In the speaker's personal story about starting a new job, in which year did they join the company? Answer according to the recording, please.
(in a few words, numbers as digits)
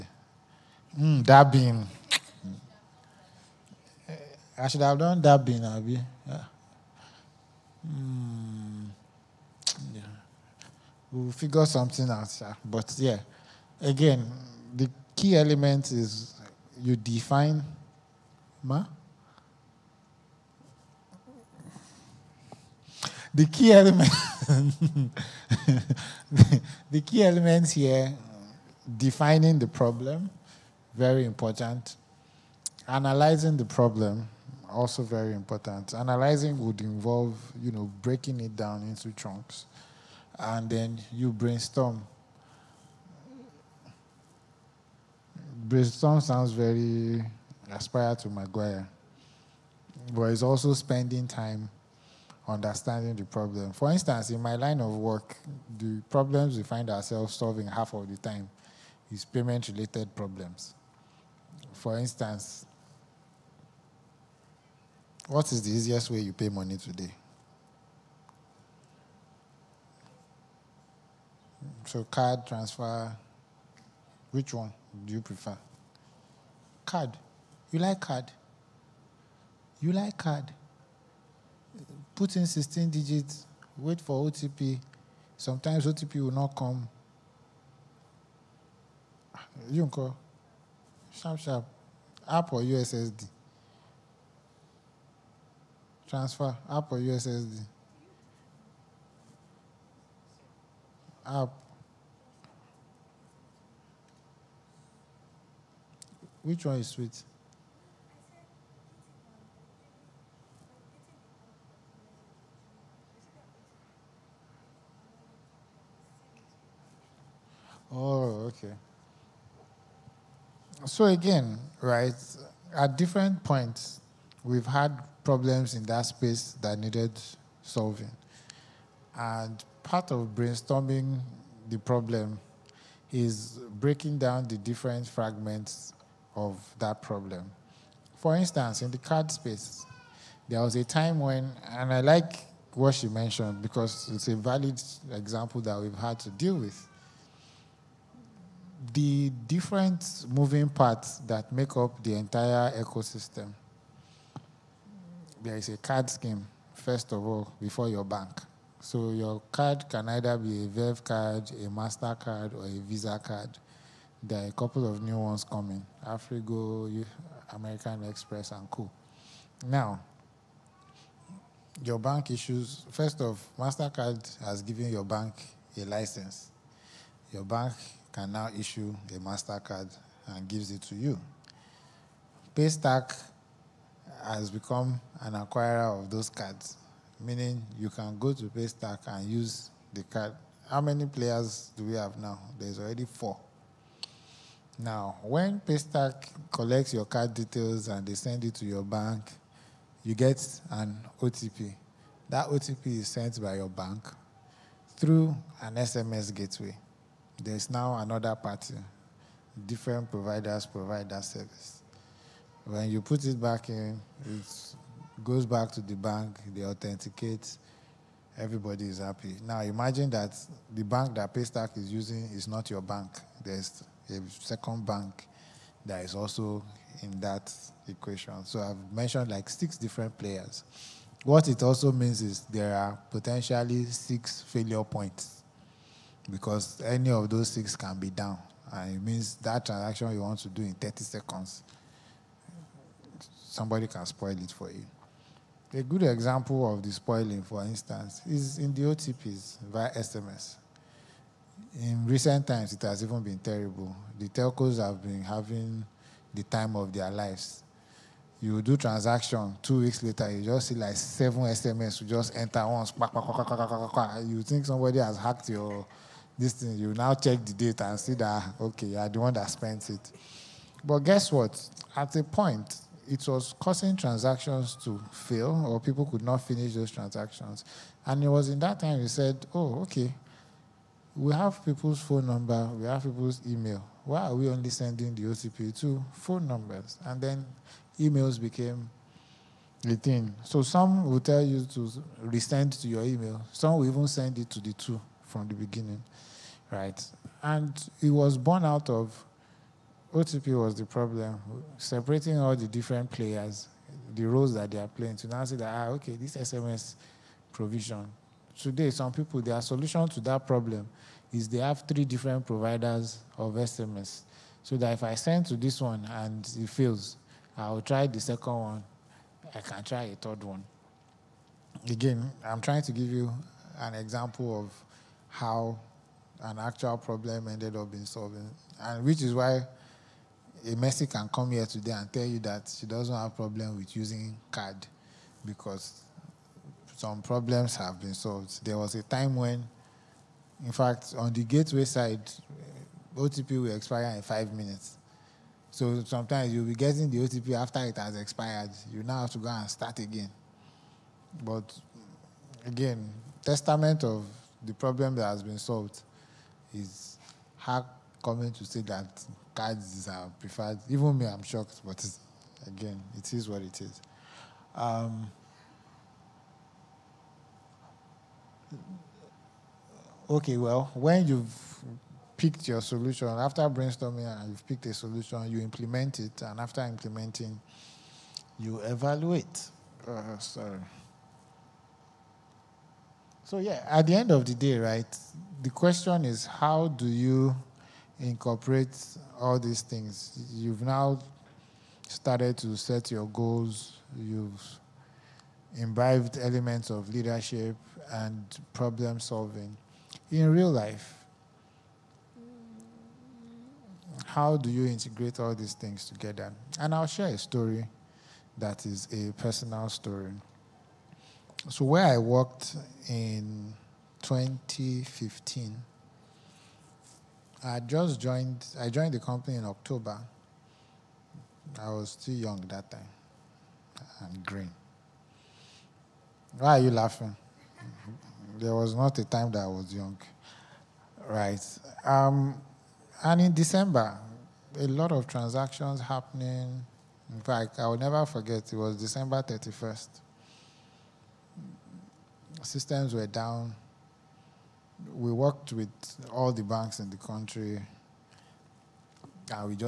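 2015.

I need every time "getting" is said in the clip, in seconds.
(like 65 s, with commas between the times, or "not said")
346 s.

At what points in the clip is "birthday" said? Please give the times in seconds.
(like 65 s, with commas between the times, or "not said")
not said.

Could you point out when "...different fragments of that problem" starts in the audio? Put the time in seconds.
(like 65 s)
134 s.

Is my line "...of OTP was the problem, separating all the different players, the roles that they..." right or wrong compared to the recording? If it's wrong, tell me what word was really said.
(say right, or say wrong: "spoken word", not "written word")
right.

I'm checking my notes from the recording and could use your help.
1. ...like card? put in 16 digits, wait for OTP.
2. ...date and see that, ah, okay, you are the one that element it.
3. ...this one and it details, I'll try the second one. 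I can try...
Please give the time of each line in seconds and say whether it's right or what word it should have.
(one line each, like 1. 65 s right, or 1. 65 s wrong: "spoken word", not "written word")
1. 79 s right
2. 267 s wrong: "spent", not "element"
3. 315 s wrong: "fails", not "details".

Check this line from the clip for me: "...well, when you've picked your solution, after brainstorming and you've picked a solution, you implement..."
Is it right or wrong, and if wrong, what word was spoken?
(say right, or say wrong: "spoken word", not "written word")
right.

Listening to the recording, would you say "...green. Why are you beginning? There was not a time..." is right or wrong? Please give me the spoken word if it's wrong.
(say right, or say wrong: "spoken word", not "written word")
wrong: "laughing", not "beginning".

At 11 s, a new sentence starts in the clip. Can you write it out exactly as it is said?
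We'll figure something out, but yeah.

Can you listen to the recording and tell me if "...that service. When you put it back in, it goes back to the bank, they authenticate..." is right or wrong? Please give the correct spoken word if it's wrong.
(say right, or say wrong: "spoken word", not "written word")
right.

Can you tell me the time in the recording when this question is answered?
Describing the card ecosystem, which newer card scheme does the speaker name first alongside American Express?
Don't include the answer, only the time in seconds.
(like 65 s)
166 s.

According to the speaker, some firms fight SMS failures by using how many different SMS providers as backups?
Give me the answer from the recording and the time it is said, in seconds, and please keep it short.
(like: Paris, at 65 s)
3, at 311 s.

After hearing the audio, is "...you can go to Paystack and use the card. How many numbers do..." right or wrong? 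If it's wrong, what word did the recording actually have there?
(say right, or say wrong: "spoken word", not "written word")
wrong: "players", not "numbers".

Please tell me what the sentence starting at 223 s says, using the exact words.
There's a second bank that is also in that equation.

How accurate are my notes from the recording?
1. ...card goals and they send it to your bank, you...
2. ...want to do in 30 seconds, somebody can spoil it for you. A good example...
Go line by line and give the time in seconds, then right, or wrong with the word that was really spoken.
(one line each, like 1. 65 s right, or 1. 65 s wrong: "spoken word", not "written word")
1. 197 s wrong: "details", not "goals"
2. 240 s right.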